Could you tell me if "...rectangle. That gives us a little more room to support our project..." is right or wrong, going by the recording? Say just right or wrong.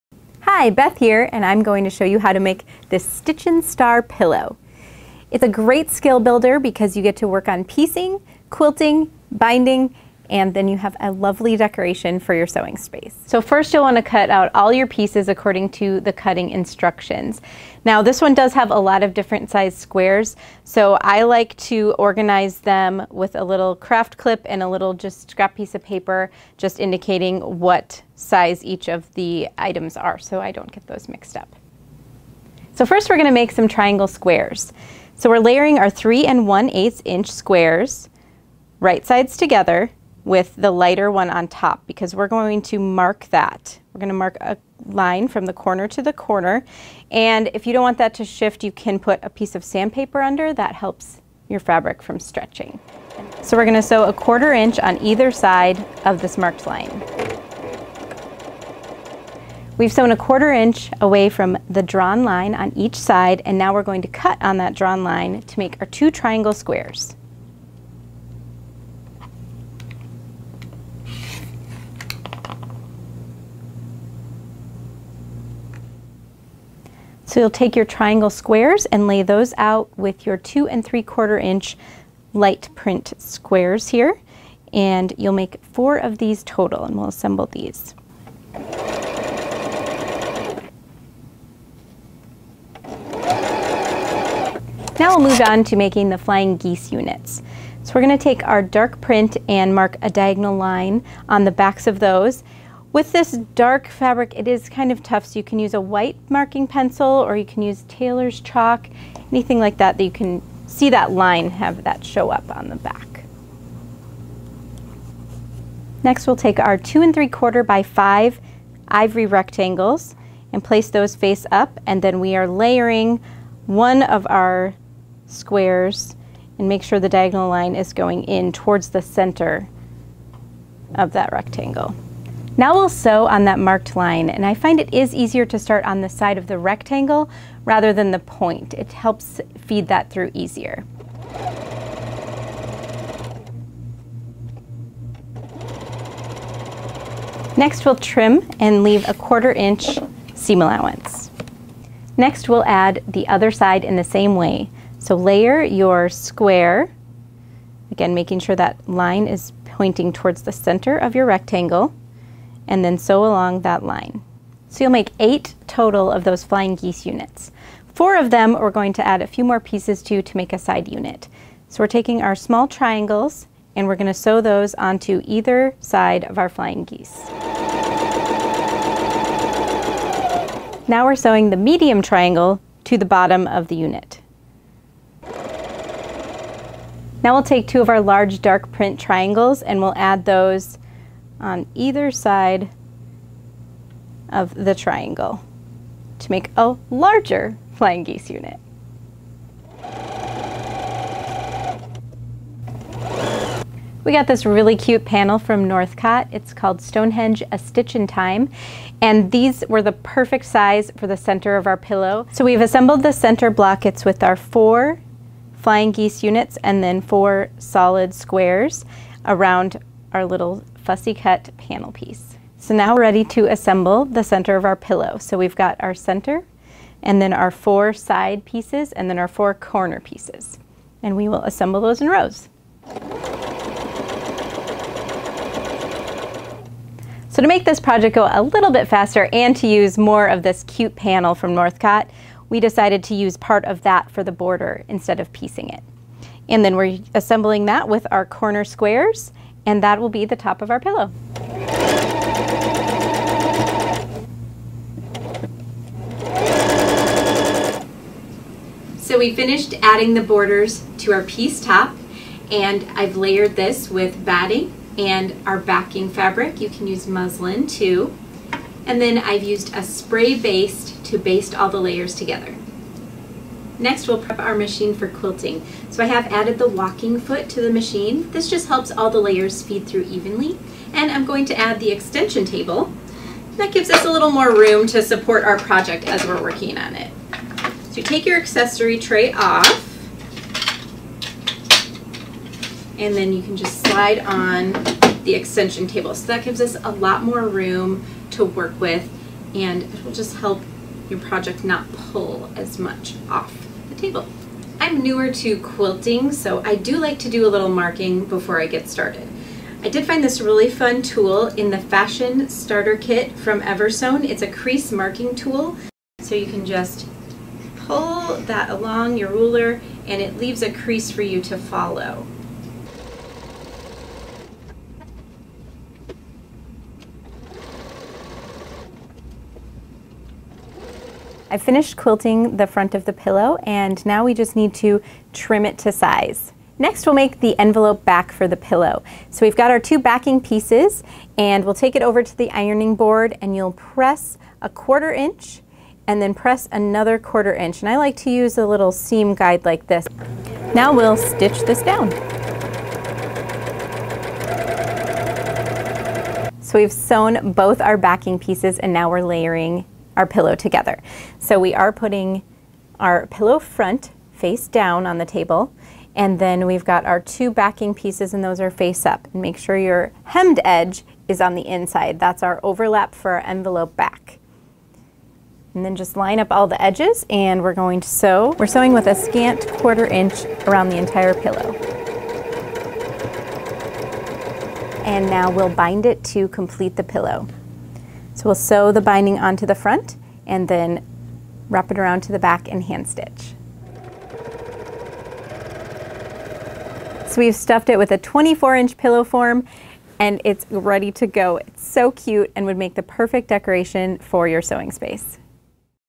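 wrong.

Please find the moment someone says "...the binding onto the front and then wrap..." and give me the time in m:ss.
6:28.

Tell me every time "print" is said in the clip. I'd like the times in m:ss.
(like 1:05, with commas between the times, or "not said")
1:22, 1:39, 3:08.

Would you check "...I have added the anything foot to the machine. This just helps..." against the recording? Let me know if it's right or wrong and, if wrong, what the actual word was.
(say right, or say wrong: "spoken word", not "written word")
wrong: "walking", not "anything".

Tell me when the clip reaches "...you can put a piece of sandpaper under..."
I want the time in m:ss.
0:48.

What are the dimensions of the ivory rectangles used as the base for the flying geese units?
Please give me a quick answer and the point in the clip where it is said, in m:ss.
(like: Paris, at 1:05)
2 3/4 by 5, at 1:56.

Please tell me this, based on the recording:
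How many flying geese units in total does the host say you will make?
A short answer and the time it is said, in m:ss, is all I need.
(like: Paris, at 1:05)
8, at 2:45.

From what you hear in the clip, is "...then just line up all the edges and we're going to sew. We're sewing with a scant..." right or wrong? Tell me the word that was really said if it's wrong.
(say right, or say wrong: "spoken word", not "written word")
right.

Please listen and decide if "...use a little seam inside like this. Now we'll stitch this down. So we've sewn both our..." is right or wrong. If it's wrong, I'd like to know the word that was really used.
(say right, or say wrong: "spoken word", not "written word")
wrong: "guide", not "inside".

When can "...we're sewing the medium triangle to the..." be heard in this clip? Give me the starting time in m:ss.
3:01.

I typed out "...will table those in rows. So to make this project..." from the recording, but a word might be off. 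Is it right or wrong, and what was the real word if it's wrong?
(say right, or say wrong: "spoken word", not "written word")
wrong: "assemble", not "table".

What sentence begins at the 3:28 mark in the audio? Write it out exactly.
And these were the perfect size for the center of our pillow.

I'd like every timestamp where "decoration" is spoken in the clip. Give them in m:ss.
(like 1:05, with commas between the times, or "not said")
0:11, 6:43.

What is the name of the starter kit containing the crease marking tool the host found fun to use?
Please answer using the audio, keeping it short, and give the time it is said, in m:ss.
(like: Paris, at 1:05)
Fashion Starter Kit, at 5:11.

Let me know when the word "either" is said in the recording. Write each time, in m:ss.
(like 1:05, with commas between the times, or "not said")
0:55, 2:55, 3:11.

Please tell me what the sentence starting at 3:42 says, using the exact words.
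So now we're ready to assemble the center of our pillow.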